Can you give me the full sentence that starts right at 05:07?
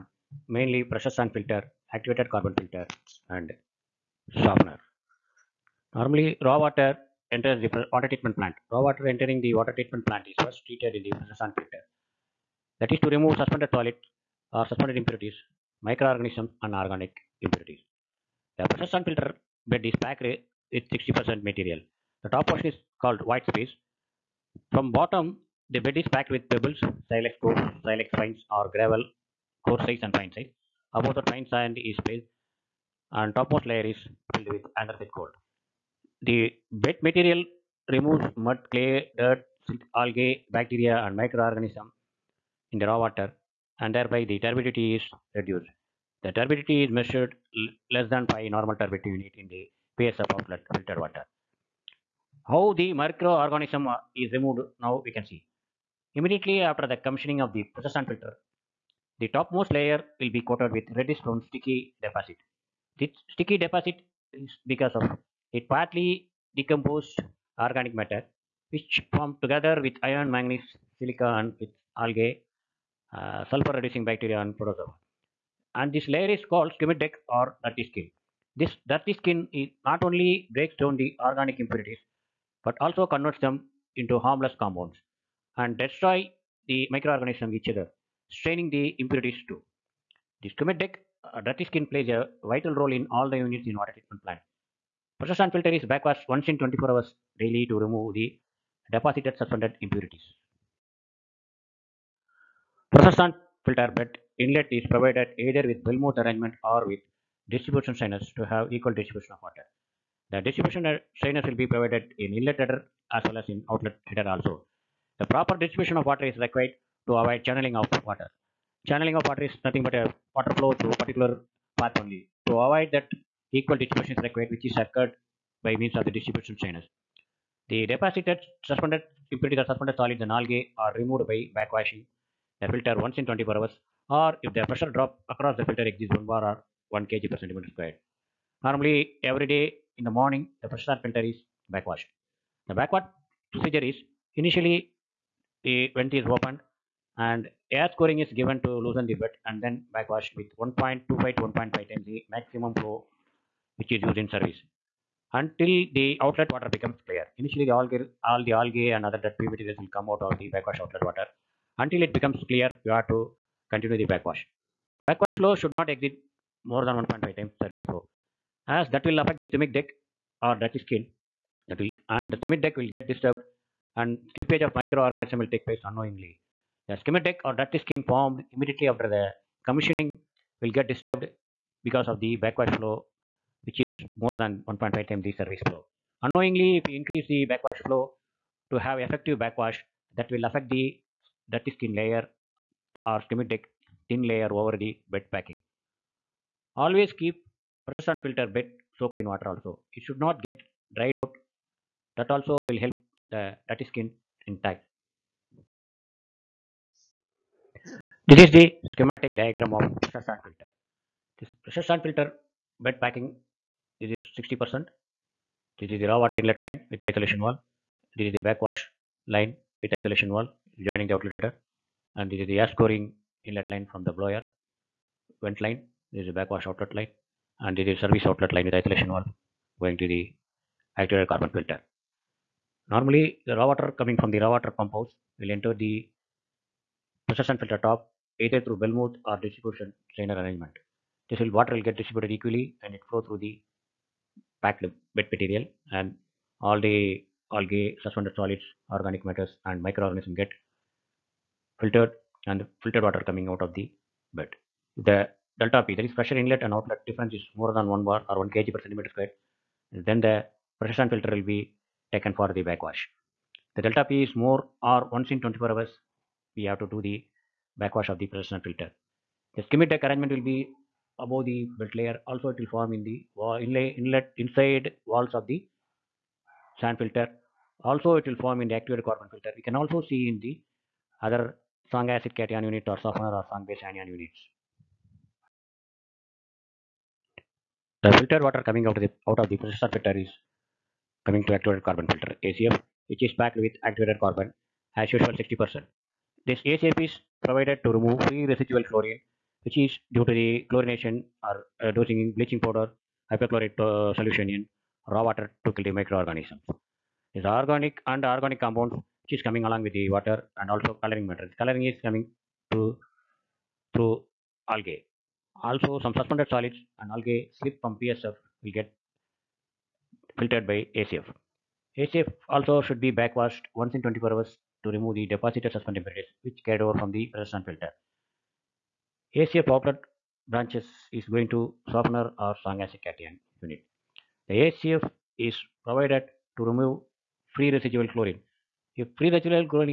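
These organic and organic compounds which is coming along with the water and also coloring material.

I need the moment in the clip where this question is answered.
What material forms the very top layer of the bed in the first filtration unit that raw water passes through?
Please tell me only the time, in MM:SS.
00:34.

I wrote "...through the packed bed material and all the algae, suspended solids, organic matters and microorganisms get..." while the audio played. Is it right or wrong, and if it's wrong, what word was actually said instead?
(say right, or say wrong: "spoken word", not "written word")
right.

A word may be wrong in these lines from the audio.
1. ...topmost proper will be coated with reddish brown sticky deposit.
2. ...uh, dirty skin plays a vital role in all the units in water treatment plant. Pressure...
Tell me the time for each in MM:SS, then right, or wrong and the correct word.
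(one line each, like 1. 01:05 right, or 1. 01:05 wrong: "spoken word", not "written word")
1. 00:59 wrong: "layer", not "proper"
2. 01:31 right.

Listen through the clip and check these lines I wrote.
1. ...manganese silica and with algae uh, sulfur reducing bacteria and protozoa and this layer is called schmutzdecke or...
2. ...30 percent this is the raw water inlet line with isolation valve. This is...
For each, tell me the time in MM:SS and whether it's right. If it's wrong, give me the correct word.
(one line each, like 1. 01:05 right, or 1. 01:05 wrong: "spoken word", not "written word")
1. 01:10 right
2. 03:34 wrong: "60", not "30".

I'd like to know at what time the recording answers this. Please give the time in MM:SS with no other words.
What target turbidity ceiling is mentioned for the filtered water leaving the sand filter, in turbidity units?
00:47.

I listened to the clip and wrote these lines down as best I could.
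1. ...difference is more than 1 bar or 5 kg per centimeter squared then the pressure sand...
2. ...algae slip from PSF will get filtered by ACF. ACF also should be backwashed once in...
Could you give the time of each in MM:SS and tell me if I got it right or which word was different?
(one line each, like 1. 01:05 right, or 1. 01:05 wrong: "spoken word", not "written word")
1. 04:17 wrong: "1", not "5"
2. 05:17 right.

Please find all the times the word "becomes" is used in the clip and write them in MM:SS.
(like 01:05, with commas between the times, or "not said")
02:36, 02:42.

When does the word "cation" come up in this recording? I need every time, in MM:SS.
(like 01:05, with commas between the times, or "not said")
04:42, 05:33.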